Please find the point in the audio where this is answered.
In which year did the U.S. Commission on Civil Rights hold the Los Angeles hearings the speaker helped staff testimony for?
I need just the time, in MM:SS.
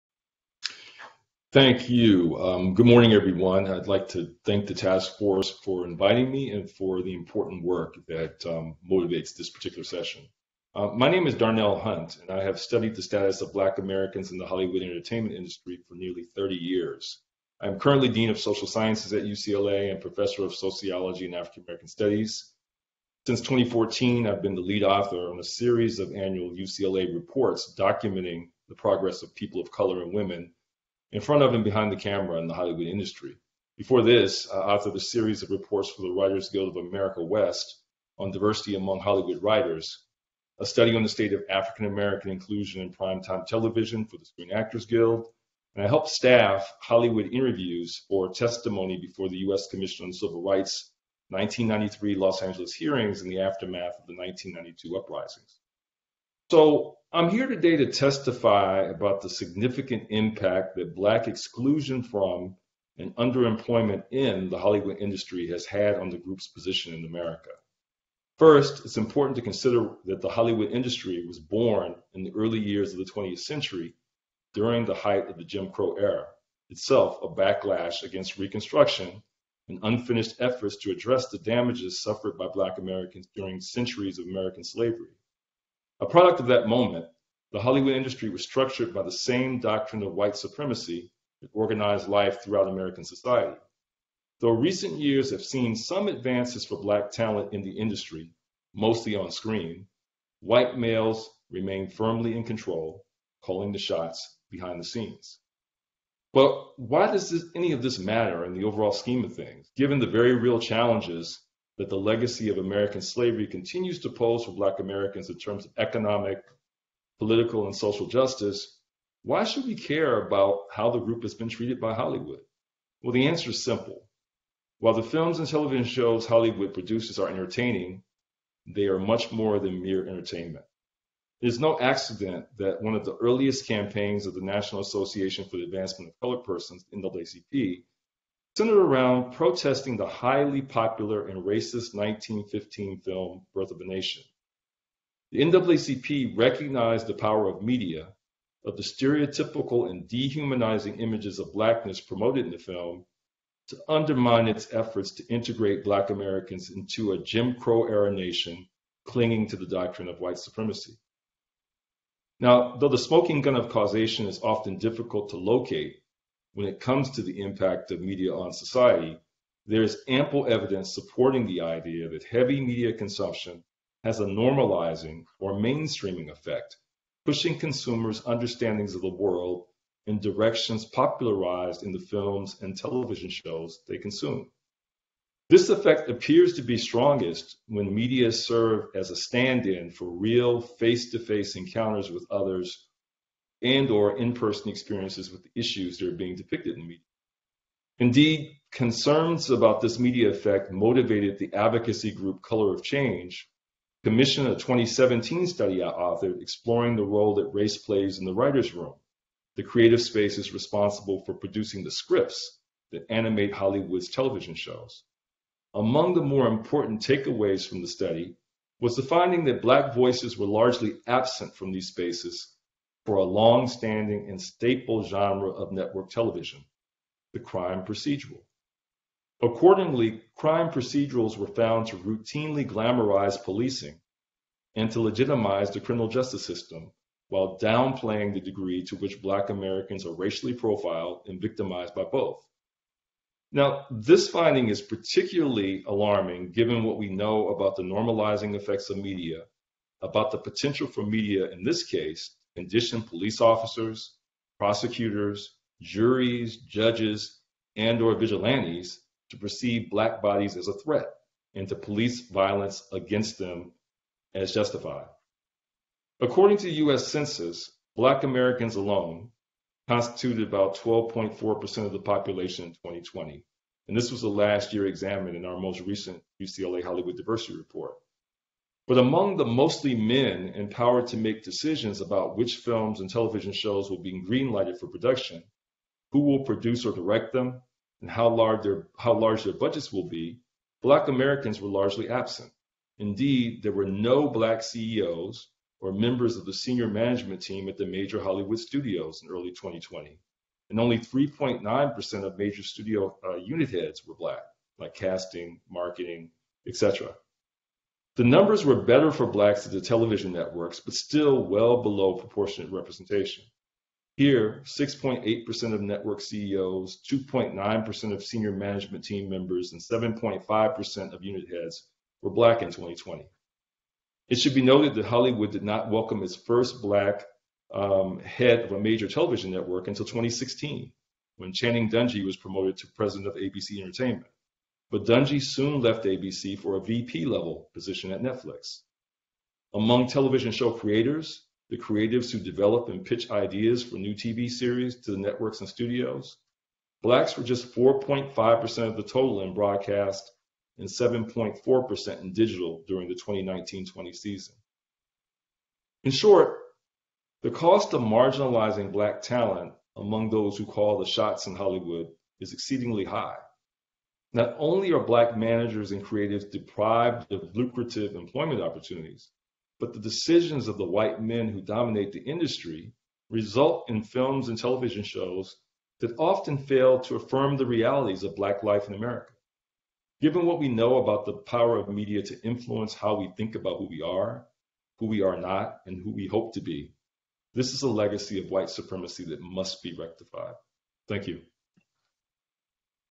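00:51.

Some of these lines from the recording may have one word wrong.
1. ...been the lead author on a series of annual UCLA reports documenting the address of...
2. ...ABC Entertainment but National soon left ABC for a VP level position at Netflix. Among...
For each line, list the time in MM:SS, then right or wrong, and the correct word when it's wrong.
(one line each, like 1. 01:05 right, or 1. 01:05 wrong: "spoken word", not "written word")
1. 00:24 wrong: "progress", not "address"
2. 05:33 wrong: "Dungey", not "National".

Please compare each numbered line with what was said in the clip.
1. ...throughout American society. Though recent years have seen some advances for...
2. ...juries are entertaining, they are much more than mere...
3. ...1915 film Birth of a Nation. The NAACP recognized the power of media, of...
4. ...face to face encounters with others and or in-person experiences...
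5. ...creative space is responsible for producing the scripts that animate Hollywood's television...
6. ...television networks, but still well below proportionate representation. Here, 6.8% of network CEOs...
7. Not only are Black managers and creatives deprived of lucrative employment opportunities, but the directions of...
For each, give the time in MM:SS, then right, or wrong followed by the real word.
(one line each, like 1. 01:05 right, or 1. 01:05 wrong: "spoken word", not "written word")
1. 01:32 right
2. 02:06 wrong: "produces", not "juries"
3. 02:21 right
4. 03:10 right
5. 03:29 right
6. 05:09 right
7. 06:04 wrong: "decisions", not "directions".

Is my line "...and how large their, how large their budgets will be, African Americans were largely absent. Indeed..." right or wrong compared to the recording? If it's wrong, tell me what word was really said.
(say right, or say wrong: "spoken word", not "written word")
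wrong: "Black", not "African".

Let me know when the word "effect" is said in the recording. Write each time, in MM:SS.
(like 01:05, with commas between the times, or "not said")
02:56, 03:05, 03:20, 04:08.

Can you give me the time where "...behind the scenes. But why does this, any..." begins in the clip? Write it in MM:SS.
01:44.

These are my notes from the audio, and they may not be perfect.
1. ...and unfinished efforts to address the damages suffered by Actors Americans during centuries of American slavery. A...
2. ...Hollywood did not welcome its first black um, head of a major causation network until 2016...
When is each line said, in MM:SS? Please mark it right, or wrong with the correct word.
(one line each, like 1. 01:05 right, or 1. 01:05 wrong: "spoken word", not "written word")
1. 01:19 wrong: "Black", not "Actors"
2. 05:25 wrong: "television", not "causation".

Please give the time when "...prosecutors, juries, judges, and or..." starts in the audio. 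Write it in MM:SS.
04:14.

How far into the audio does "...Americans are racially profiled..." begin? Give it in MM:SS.
03:59.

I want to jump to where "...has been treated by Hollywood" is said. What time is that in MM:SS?
02:01.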